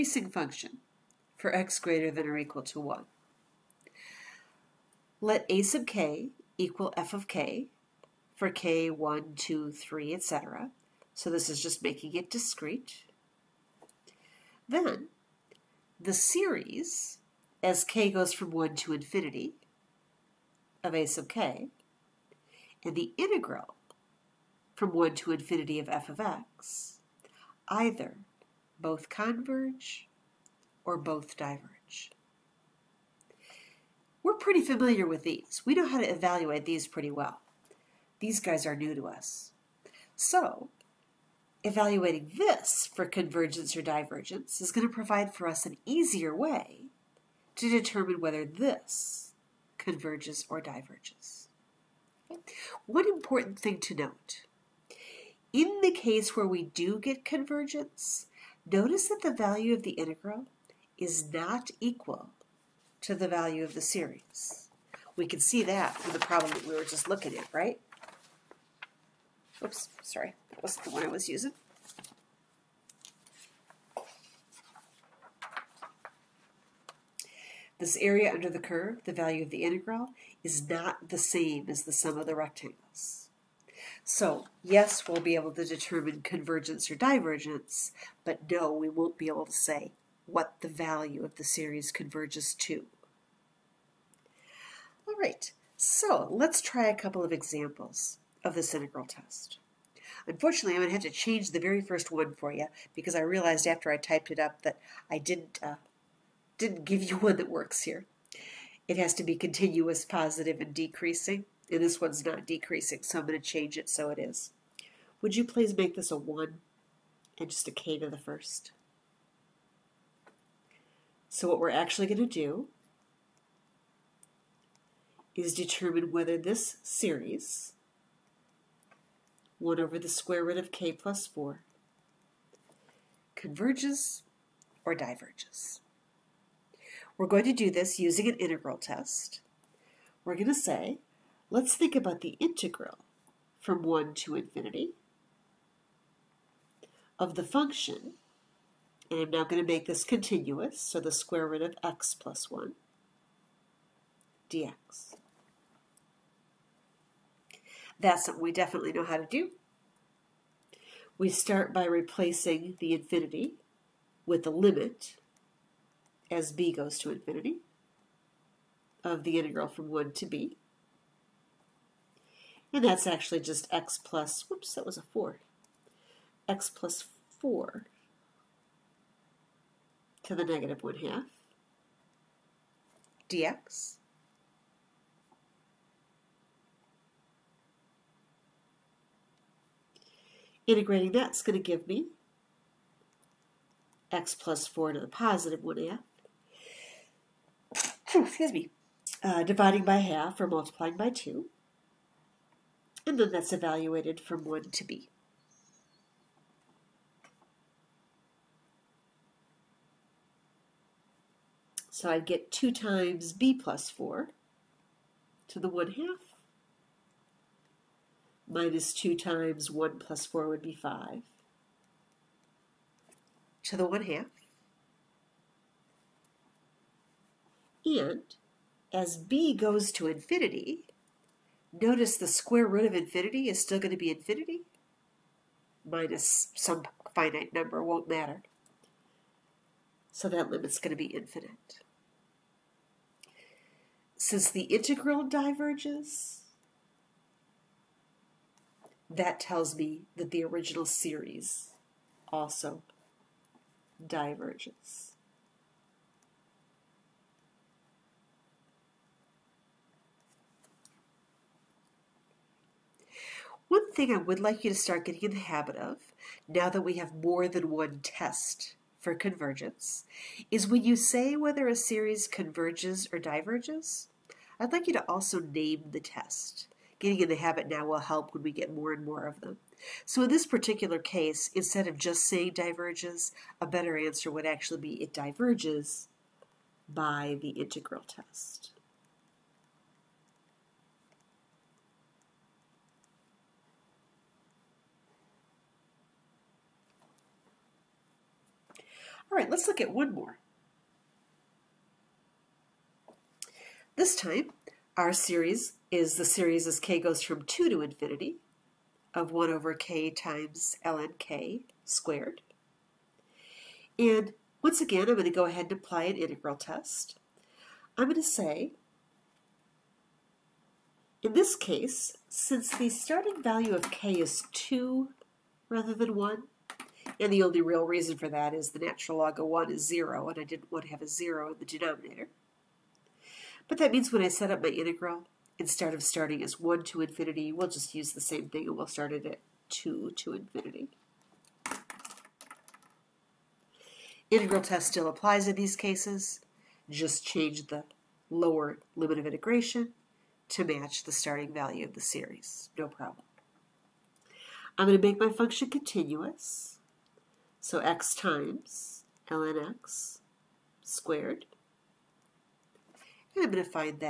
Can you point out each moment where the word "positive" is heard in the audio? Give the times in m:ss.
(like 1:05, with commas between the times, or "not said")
1:50, 3:15.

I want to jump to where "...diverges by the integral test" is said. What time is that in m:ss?
4:45.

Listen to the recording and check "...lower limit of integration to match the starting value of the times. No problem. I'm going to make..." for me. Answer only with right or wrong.
wrong.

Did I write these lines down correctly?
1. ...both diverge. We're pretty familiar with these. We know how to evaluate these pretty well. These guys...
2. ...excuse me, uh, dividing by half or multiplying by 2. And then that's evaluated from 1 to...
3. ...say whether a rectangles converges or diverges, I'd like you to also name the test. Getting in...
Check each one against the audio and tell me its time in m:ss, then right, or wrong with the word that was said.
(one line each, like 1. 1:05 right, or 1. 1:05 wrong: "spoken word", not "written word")
1. 0:30 right
2. 3:18 right
3. 4:30 wrong: "series", not "rectangles".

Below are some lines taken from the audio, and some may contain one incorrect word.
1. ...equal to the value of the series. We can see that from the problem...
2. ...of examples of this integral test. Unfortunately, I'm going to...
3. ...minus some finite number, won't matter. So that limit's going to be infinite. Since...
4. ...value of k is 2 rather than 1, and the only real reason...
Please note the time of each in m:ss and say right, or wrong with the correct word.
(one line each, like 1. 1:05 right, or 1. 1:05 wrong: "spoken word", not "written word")
1. 1:01 right
2. 1:37 right
3. 3:55 right
4. 5:23 right.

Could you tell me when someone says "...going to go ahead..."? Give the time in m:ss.
5:15.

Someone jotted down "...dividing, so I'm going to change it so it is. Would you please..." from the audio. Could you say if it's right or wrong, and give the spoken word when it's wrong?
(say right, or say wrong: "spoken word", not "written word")
wrong: "decreasing", not "dividing".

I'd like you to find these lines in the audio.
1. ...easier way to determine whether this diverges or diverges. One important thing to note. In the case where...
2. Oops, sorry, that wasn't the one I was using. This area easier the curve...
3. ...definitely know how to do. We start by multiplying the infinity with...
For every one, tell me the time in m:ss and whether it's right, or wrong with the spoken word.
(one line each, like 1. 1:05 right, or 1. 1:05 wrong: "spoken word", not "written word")
1. 0:45 wrong: "converges", not "diverges"
2. 1:09 wrong: "under", not "easier"
3. 2:38 wrong: "replacing", not "multiplying".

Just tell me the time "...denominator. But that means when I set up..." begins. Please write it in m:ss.
5:31.